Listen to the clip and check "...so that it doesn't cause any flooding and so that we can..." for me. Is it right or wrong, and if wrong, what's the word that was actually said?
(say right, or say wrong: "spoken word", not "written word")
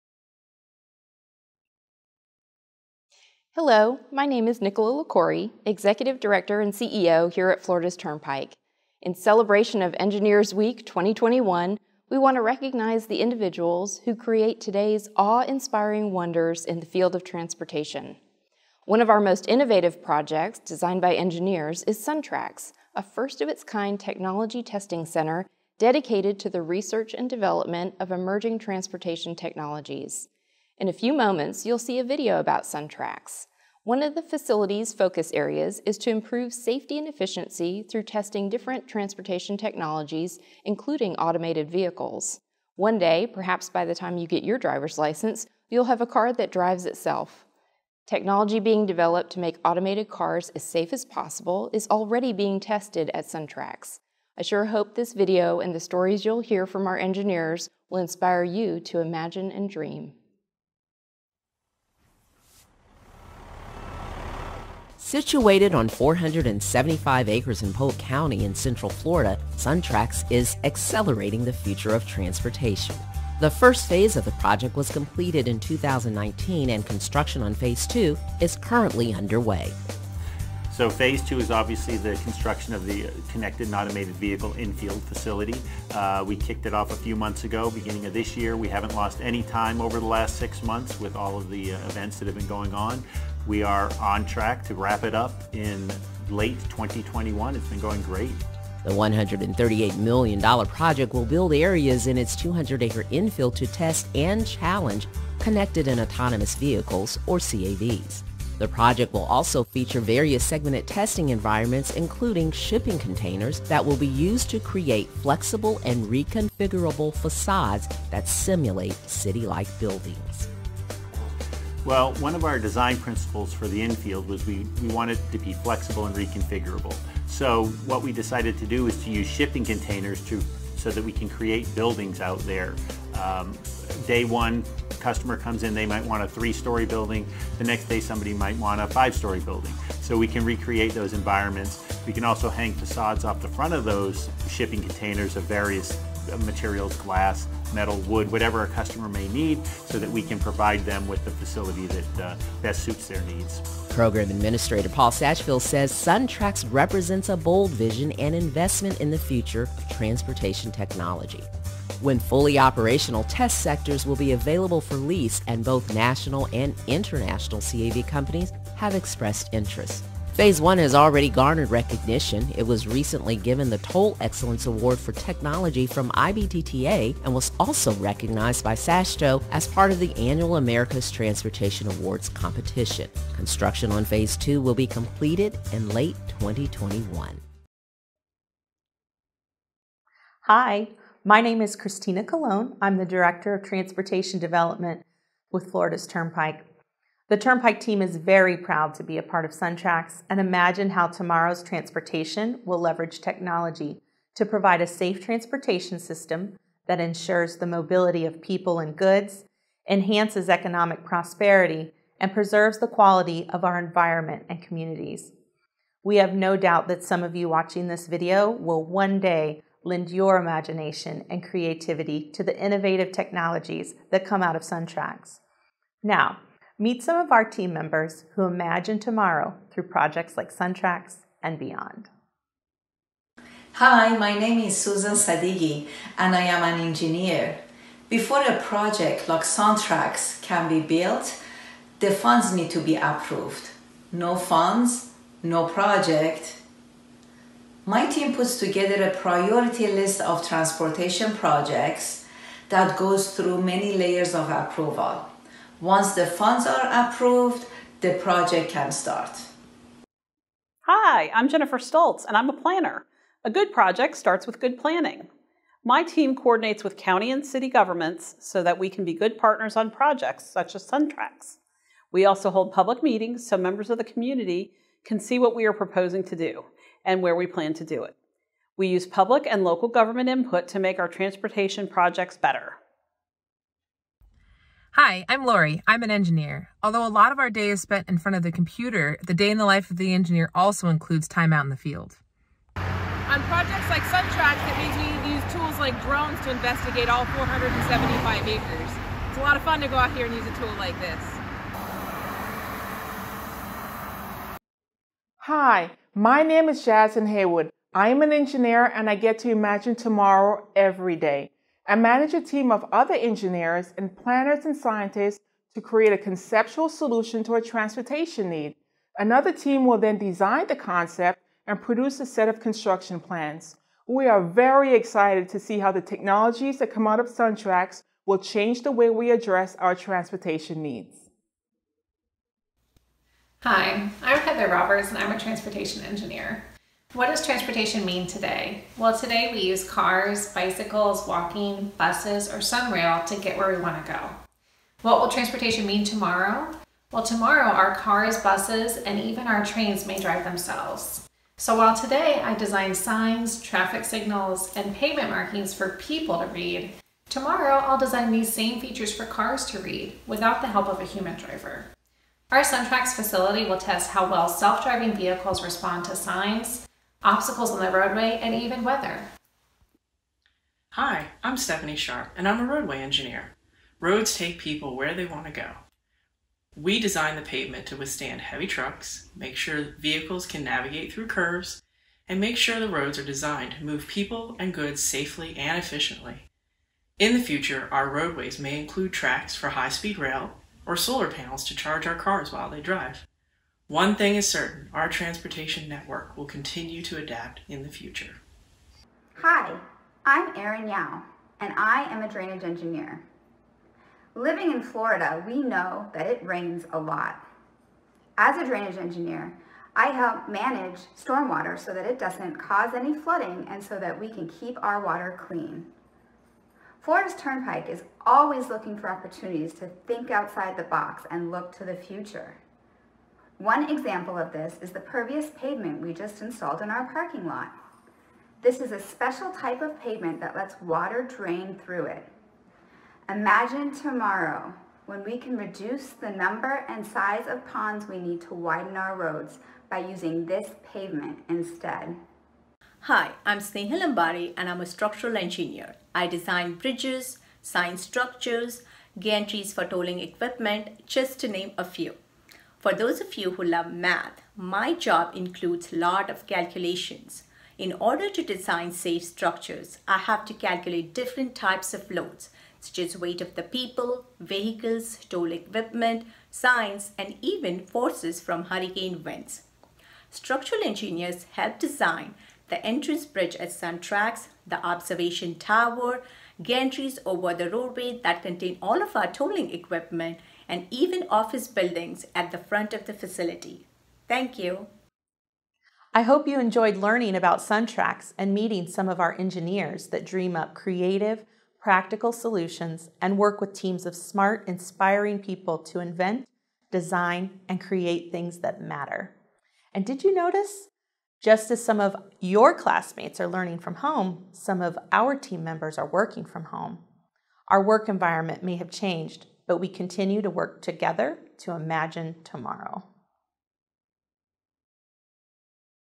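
right.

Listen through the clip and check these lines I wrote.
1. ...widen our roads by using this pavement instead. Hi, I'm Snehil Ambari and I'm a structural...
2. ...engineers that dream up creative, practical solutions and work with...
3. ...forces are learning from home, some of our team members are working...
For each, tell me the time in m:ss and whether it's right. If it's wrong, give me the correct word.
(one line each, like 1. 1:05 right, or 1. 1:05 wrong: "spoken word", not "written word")
1. 7:18 right
2. 8:09 right
3. 8:22 wrong: "classmates", not "forces".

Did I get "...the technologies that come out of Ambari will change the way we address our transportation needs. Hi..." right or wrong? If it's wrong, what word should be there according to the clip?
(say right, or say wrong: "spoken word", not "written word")
wrong: "SunTrax", not "Ambari".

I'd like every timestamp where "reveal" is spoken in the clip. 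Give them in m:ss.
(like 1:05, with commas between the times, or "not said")
not said.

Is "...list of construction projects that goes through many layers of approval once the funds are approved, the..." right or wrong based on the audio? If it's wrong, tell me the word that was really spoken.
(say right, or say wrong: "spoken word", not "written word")
wrong: "transportation", not "construction".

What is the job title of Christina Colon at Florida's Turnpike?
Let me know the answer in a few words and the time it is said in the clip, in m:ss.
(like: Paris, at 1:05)
Director of Transportation Development, at 3:13.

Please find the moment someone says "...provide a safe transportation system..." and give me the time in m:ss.
3:24.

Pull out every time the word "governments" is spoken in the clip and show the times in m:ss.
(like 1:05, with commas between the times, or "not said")
4:27, 4:39.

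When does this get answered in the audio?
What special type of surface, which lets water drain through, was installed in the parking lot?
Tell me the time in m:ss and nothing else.
7:04.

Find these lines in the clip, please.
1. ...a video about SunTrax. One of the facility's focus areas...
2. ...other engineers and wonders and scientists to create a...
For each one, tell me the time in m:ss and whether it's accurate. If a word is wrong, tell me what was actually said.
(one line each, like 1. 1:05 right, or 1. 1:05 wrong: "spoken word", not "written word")
1. 0:31 right
2. 5:12 wrong: "planners", not "wonders".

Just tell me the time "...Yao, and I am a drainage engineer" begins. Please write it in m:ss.
6:40.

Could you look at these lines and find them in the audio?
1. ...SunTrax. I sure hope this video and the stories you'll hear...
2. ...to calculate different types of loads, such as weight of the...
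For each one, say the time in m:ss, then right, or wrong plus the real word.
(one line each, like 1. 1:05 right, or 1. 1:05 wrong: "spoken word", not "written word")
1. 0:53 right
2. 7:40 right.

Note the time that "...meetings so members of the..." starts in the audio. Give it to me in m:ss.
4:33.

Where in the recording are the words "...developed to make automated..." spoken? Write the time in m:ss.
0:48.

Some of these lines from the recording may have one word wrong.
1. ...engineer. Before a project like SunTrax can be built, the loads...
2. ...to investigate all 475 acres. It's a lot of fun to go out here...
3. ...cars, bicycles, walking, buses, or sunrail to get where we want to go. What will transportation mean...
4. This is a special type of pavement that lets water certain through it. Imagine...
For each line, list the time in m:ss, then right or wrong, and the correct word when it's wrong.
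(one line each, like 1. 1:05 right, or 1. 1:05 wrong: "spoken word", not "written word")
1. 3:56 wrong: "funds", not "loads"
2. 4:56 right
3. 5:39 right
4. 7:08 wrong: "drain", not "certain".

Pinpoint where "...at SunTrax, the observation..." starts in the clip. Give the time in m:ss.
7:53.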